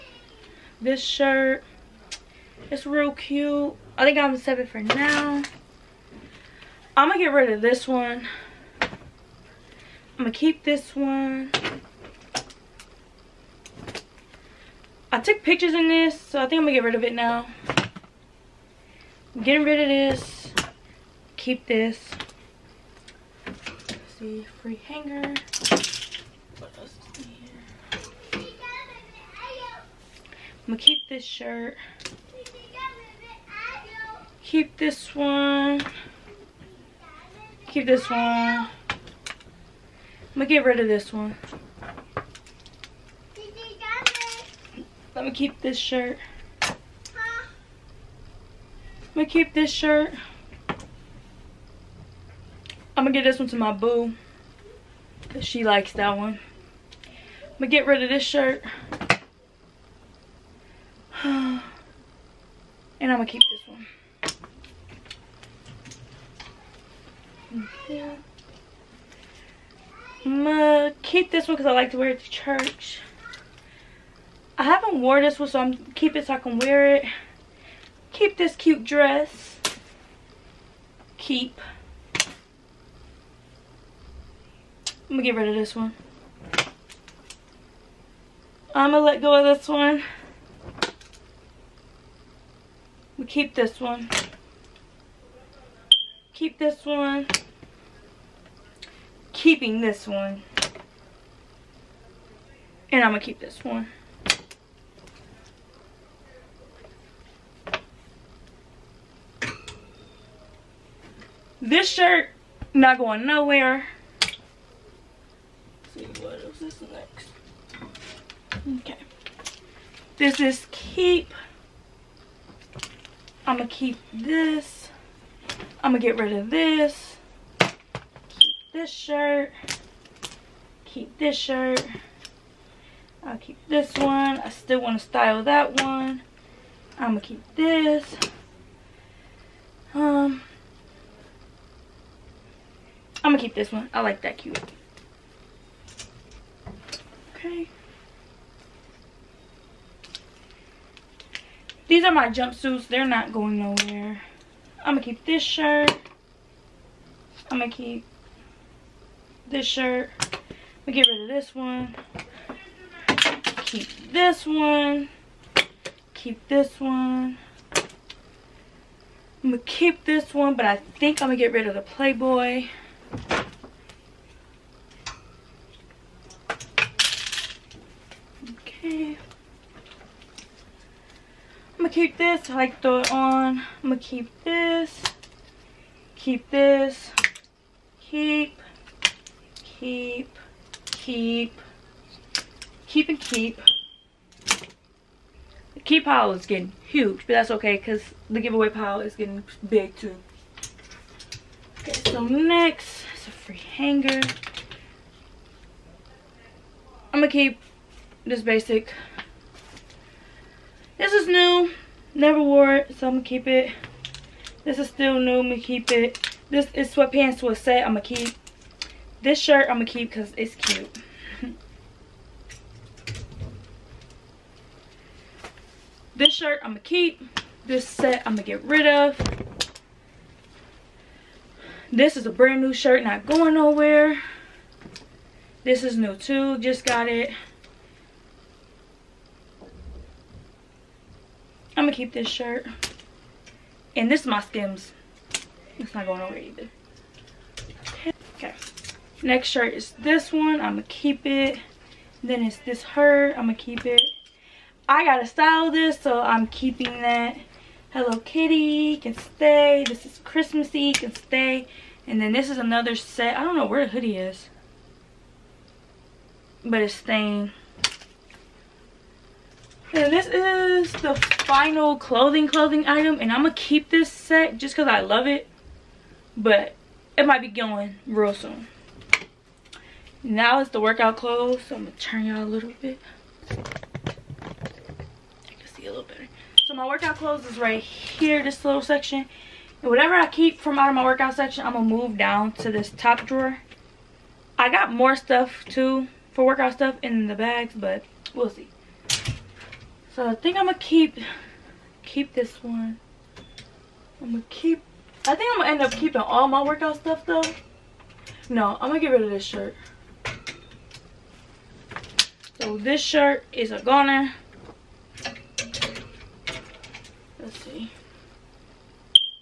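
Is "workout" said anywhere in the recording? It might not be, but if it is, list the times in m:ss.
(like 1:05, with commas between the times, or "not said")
4:40, 4:46, 4:51, 4:56, 5:06.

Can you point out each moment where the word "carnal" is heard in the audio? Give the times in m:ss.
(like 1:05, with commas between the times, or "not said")
not said.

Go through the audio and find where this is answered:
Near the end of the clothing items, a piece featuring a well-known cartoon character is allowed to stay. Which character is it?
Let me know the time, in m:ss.
4:17.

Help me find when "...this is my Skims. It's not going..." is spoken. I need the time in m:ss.
4:04.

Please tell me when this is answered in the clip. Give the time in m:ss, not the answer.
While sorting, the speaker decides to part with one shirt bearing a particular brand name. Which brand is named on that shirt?
2:51.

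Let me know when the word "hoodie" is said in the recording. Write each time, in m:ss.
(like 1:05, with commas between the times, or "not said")
4:23.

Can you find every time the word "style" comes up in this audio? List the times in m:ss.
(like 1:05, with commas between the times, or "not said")
2:15, 4:15.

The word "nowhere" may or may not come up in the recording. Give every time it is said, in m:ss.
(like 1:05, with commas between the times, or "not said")
1:53, 2:33, 3:53, 4:06.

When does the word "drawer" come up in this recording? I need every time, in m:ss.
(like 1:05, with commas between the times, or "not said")
4:53.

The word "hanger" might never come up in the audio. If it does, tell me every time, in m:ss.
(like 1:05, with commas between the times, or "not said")
0:24, 3:23.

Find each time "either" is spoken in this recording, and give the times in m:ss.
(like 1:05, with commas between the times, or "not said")
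4:06.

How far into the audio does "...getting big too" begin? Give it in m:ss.
3:19.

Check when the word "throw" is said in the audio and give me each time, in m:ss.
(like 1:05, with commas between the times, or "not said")
3:02.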